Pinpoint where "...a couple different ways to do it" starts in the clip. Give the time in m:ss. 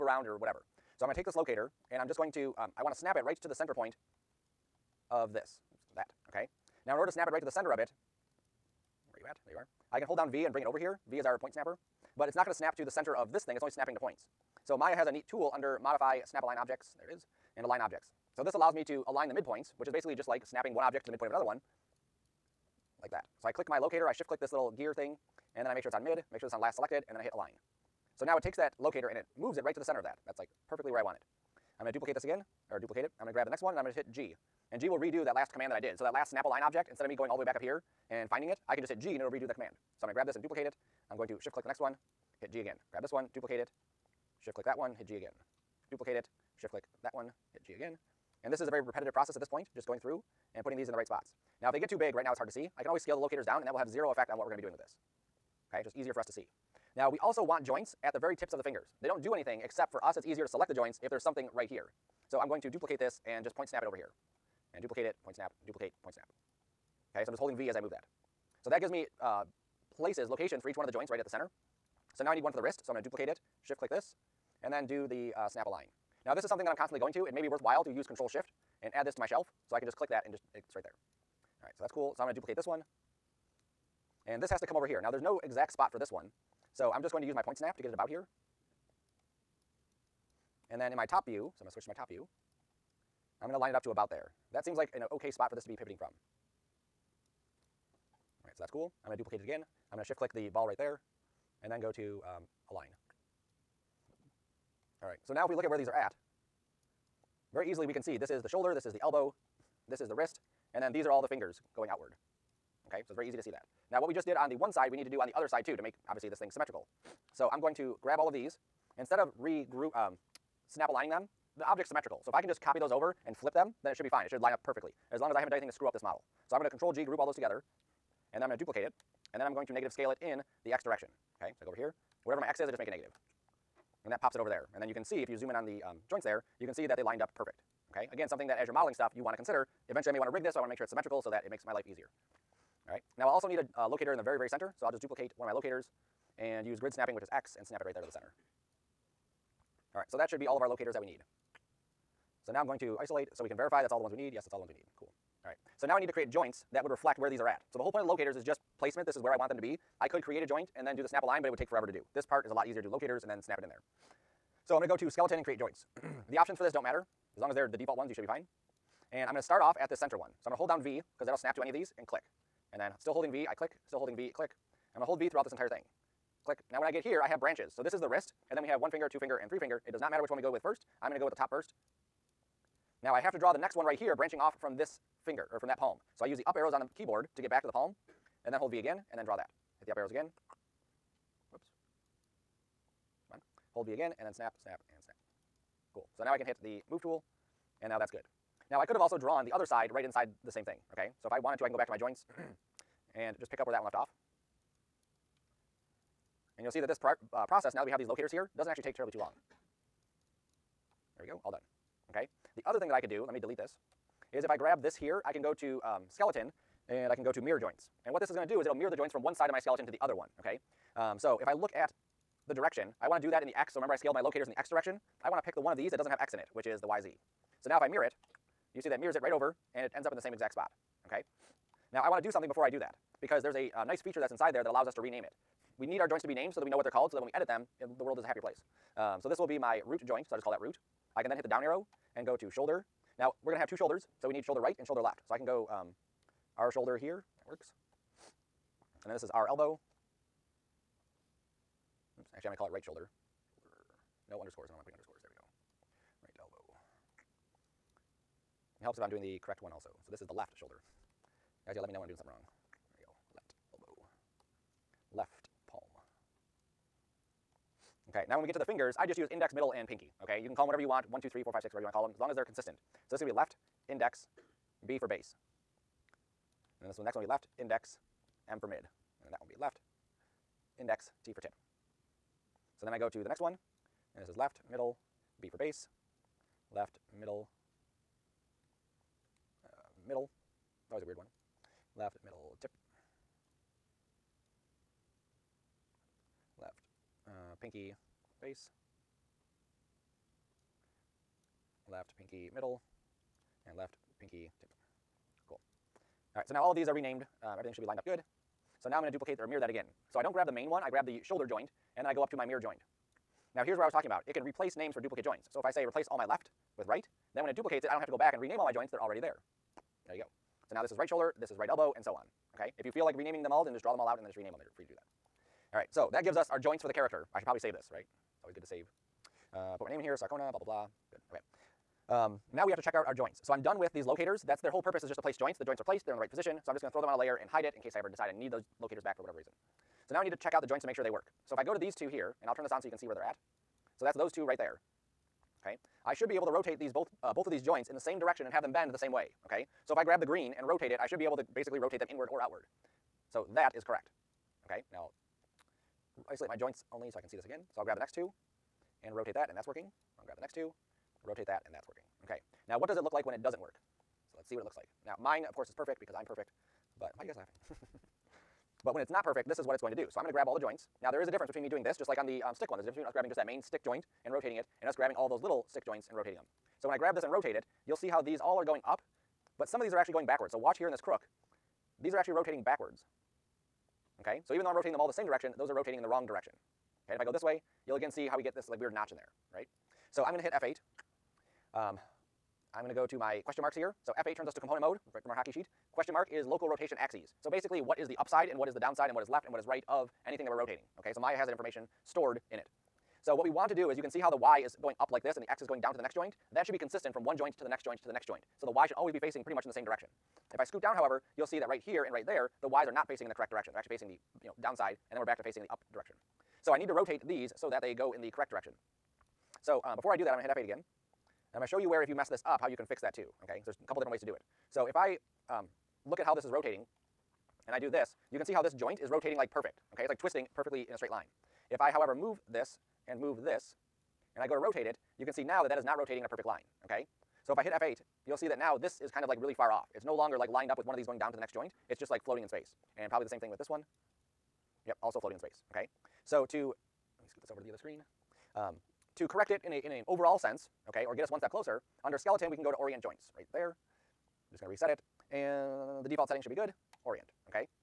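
7:03.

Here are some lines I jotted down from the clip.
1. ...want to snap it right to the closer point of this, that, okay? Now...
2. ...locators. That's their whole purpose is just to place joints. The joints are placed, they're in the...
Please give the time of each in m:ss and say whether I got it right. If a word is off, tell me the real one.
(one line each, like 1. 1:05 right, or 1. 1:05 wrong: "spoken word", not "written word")
1. 0:02 wrong: "center", not "closer"
2. 5:34 right.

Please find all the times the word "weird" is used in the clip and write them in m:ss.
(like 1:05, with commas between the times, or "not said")
4:51, 6:28.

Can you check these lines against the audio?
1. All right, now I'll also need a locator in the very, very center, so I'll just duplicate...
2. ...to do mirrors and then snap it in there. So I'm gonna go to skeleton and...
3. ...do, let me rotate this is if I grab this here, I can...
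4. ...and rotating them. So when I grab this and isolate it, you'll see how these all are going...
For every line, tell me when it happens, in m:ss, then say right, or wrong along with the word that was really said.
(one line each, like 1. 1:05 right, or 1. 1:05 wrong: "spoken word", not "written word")
1. 2:22 right
2. 2:42 wrong: "locators", not "mirrors"
3. 3:33 wrong: "delete", not "rotate"
4. 6:16 wrong: "rotate", not "isolate".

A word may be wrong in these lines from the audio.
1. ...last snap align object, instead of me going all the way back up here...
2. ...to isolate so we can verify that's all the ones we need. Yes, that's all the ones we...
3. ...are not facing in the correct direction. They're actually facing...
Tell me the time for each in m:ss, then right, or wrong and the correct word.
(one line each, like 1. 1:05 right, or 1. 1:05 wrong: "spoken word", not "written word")
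1. 0:36 right
2. 2:32 right
3. 6:52 right.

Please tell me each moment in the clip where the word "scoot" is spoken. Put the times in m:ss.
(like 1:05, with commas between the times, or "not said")
6:50, 7:27.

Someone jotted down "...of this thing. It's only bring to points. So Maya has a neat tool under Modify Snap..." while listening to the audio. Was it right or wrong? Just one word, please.
wrong.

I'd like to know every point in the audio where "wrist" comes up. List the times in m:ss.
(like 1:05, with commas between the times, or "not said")
1:12, 1:50, 2:58.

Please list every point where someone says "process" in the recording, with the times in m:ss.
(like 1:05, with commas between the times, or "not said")
0:49, 3:27.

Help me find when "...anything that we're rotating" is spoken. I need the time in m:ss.
6:40.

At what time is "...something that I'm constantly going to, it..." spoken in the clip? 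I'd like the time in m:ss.
1:16.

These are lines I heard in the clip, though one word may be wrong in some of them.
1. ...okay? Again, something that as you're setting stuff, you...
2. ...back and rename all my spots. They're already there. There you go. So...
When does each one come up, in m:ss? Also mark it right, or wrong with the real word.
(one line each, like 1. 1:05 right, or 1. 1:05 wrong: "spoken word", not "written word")
1. 2:17 wrong: "modeling", not "setting"
2. 5:18 wrong: "joints", not "spots".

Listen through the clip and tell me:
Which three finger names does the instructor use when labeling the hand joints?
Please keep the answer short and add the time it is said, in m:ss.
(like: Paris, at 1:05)
index, middle, and pinky, at 4:29.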